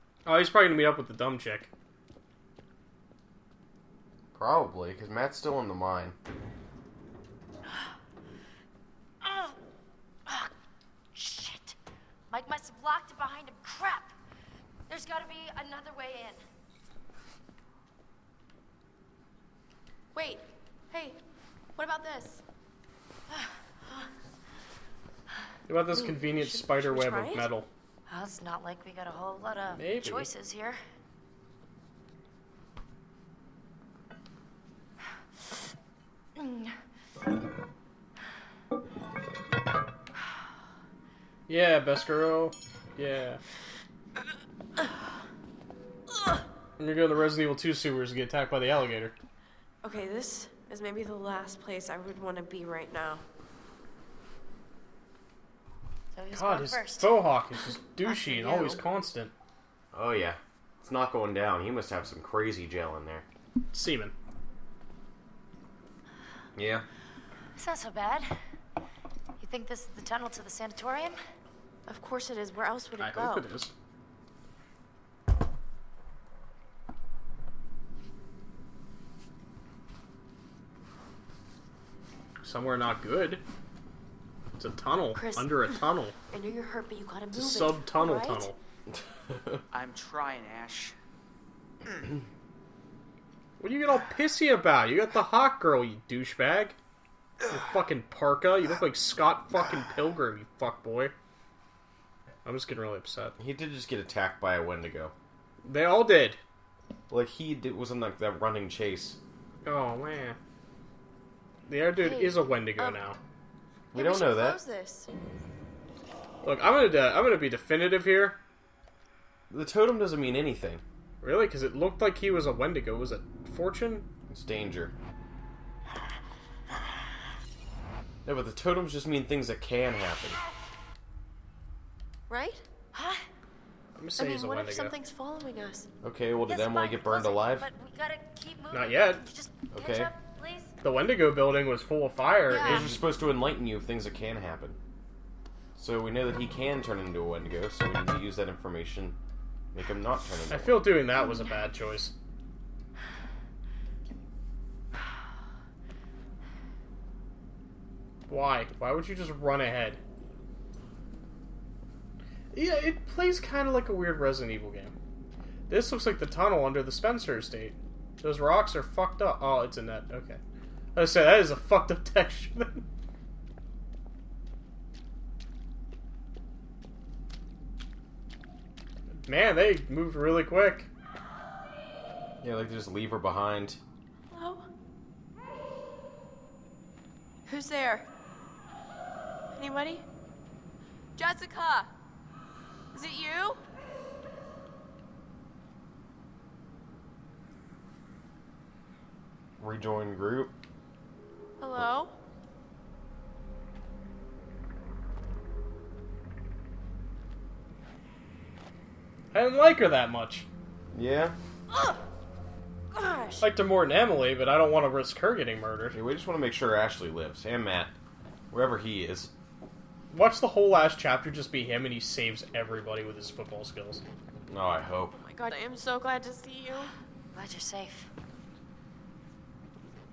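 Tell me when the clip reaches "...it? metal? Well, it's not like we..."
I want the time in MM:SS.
00:27.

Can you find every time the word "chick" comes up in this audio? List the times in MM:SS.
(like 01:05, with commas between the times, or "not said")
00:01.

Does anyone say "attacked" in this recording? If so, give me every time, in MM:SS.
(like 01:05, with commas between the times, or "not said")
00:48, 01:43.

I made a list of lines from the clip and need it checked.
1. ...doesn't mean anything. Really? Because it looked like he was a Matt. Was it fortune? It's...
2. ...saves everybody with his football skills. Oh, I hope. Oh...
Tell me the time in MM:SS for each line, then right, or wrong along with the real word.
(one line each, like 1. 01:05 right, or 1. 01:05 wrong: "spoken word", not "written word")
1. 01:59 wrong: "Wendigo", not "Matt"
2. 03:41 right.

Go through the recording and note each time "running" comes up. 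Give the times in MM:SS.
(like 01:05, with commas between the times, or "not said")
01:48.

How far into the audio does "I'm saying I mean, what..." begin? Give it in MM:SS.
02:13.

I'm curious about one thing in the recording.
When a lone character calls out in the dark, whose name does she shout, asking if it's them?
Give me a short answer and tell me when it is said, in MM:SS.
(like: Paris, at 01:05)
Jessica, at 03:11.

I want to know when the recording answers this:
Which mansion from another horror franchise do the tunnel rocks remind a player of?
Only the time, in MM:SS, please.
02:46.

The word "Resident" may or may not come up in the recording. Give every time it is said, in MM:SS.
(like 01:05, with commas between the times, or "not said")
00:47, 02:44.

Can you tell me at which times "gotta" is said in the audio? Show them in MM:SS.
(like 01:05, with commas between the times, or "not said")
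00:15, 01:27.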